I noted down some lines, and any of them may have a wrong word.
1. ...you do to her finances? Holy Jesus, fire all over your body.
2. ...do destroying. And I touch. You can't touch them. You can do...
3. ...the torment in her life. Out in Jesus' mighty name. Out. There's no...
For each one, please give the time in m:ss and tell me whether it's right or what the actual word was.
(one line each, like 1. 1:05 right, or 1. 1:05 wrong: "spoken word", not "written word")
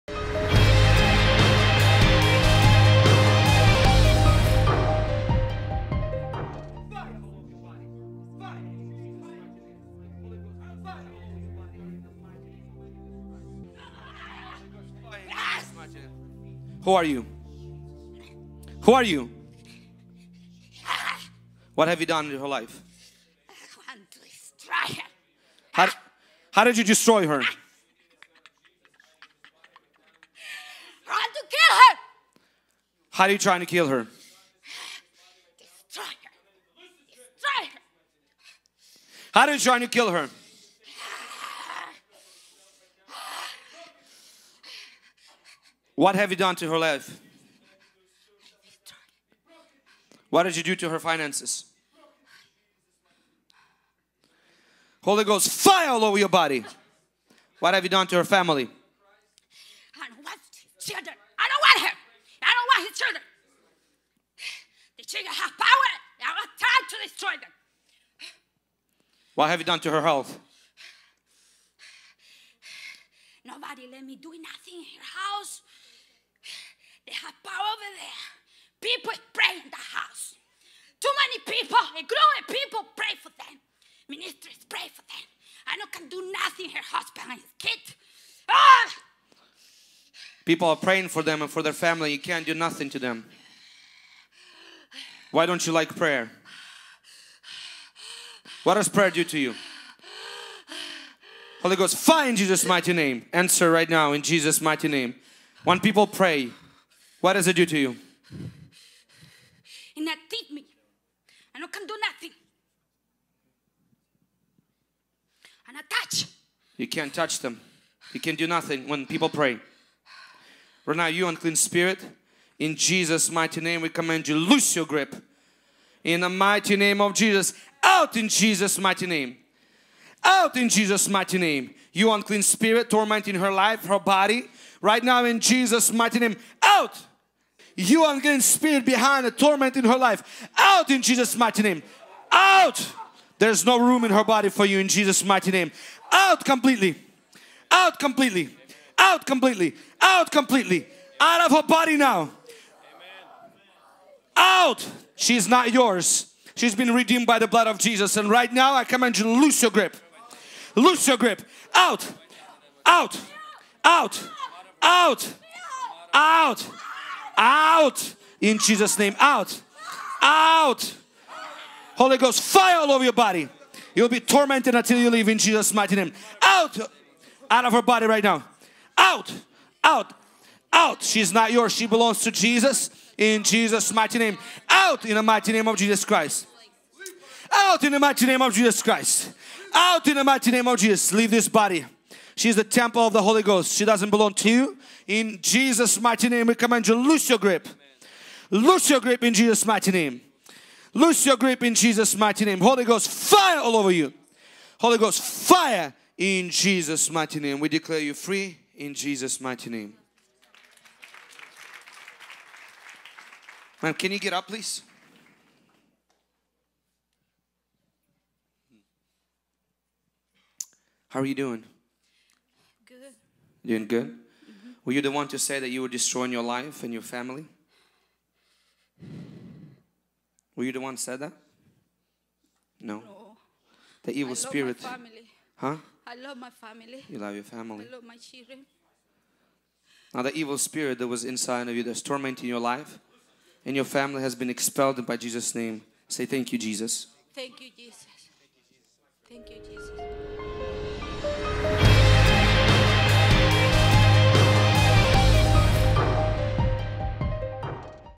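1. 0:50 wrong: "Ghost", not "Jesus"
2. 1:51 wrong: "nothing", not "destroying"
3. 2:19 right.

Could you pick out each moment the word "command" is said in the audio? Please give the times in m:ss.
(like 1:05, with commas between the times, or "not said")
2:03, 2:38, 3:16.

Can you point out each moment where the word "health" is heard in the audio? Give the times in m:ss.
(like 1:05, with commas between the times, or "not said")
1:10.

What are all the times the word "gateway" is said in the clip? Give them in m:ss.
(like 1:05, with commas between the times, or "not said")
not said.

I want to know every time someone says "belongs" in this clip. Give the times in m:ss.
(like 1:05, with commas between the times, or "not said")
3:01, 3:14.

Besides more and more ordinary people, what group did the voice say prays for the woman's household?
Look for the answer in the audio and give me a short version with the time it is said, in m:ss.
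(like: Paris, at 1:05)
Ministers, at 1:24.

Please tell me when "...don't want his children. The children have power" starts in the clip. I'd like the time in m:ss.
1:02.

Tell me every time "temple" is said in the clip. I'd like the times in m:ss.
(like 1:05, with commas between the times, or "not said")
3:12.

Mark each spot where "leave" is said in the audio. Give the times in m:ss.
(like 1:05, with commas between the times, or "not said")
2:55, 3:11.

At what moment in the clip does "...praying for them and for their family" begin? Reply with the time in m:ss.
1:30.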